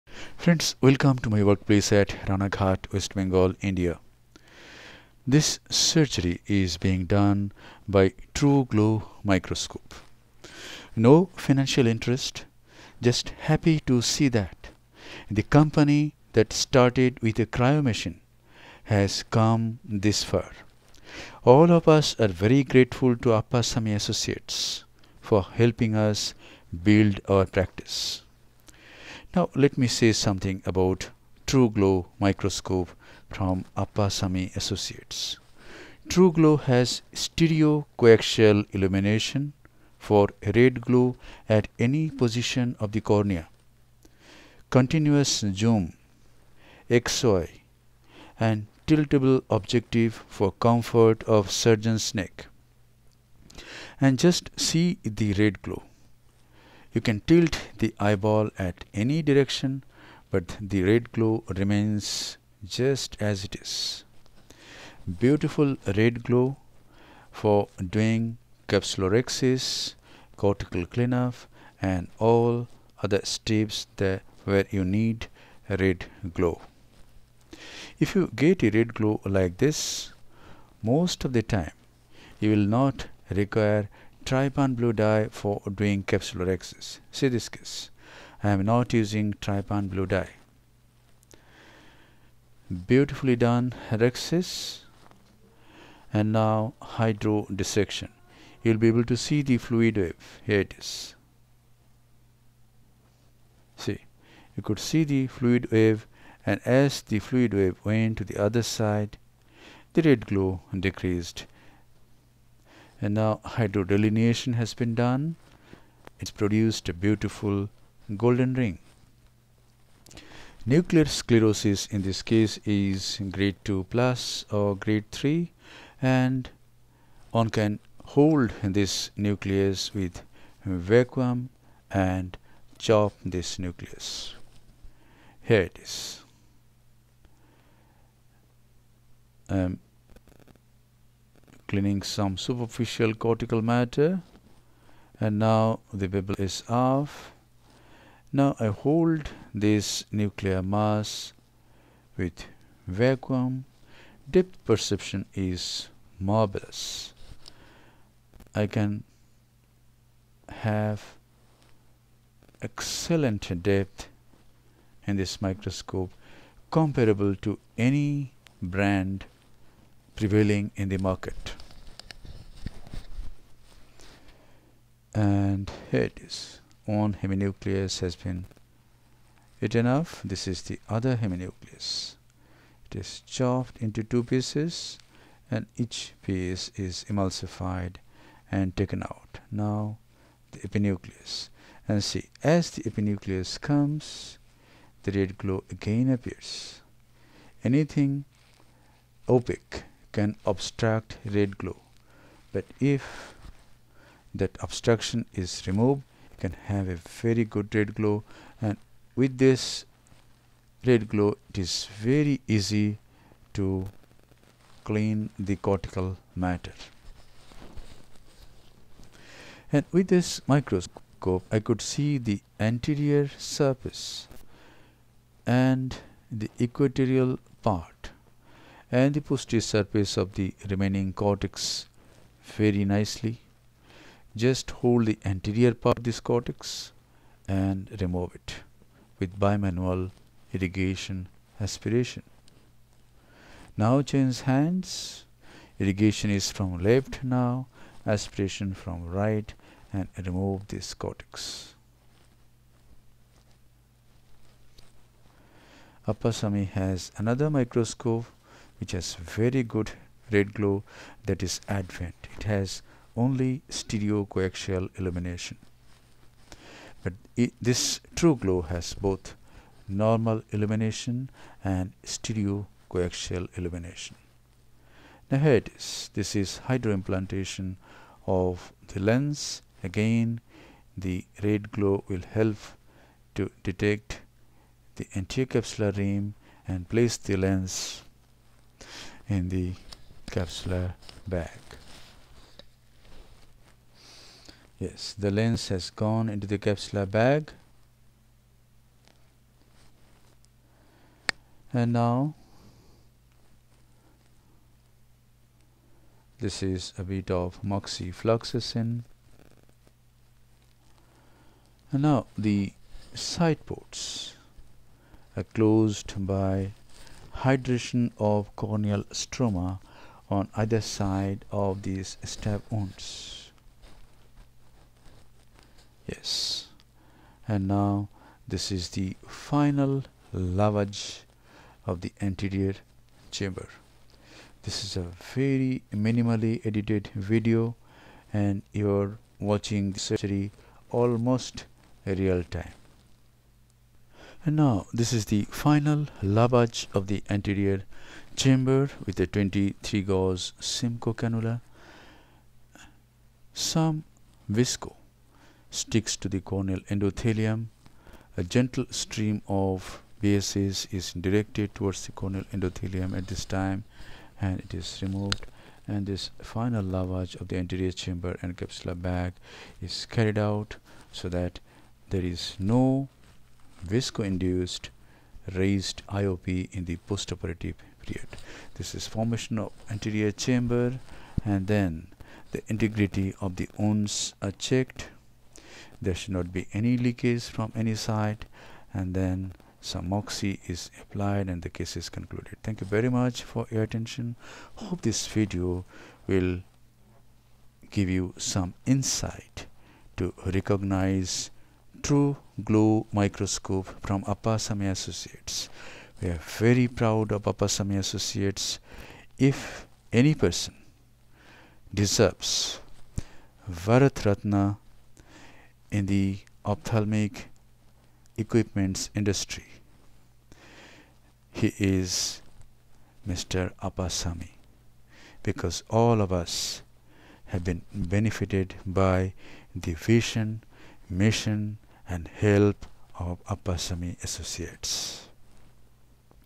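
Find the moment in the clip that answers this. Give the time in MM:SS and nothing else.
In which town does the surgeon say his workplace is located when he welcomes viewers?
00:02.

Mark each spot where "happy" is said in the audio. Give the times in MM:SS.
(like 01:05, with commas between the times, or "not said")
00:13.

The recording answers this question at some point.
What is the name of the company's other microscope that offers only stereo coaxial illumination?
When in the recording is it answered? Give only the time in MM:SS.
04:21.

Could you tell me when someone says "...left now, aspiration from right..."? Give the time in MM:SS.
04:06.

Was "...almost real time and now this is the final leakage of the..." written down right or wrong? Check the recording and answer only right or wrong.
wrong.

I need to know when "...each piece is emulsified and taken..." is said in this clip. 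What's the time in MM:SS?
03:05.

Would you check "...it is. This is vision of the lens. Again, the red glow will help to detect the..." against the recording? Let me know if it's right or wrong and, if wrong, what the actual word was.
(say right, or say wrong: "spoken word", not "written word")
wrong: "hydroimplantation", not "vision".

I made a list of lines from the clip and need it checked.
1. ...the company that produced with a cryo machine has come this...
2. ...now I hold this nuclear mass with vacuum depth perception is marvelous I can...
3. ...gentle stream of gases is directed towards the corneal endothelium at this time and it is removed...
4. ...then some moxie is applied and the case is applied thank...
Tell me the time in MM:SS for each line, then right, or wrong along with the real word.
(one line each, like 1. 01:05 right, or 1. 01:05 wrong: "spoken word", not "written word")
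1. 00:15 wrong: "started", not "produced"
2. 02:28 right
3. 05:58 right
4. 06:29 wrong: "concluded", not "applied".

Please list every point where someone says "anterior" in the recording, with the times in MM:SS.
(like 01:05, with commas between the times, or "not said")
03:42, 03:55, 04:45, 05:32, 05:47, 06:07, 06:19.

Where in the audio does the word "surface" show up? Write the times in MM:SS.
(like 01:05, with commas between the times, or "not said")
03:43, 03:49.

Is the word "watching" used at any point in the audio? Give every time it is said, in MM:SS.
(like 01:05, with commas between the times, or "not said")
05:39.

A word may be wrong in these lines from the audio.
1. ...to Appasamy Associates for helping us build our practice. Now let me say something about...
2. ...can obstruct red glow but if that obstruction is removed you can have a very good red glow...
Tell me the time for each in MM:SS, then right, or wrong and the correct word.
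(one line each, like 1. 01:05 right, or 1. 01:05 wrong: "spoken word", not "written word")
1. 00:23 right
2. 03:20 right.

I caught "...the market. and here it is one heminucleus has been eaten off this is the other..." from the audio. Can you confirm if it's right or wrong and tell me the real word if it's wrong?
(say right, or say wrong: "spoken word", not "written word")
right.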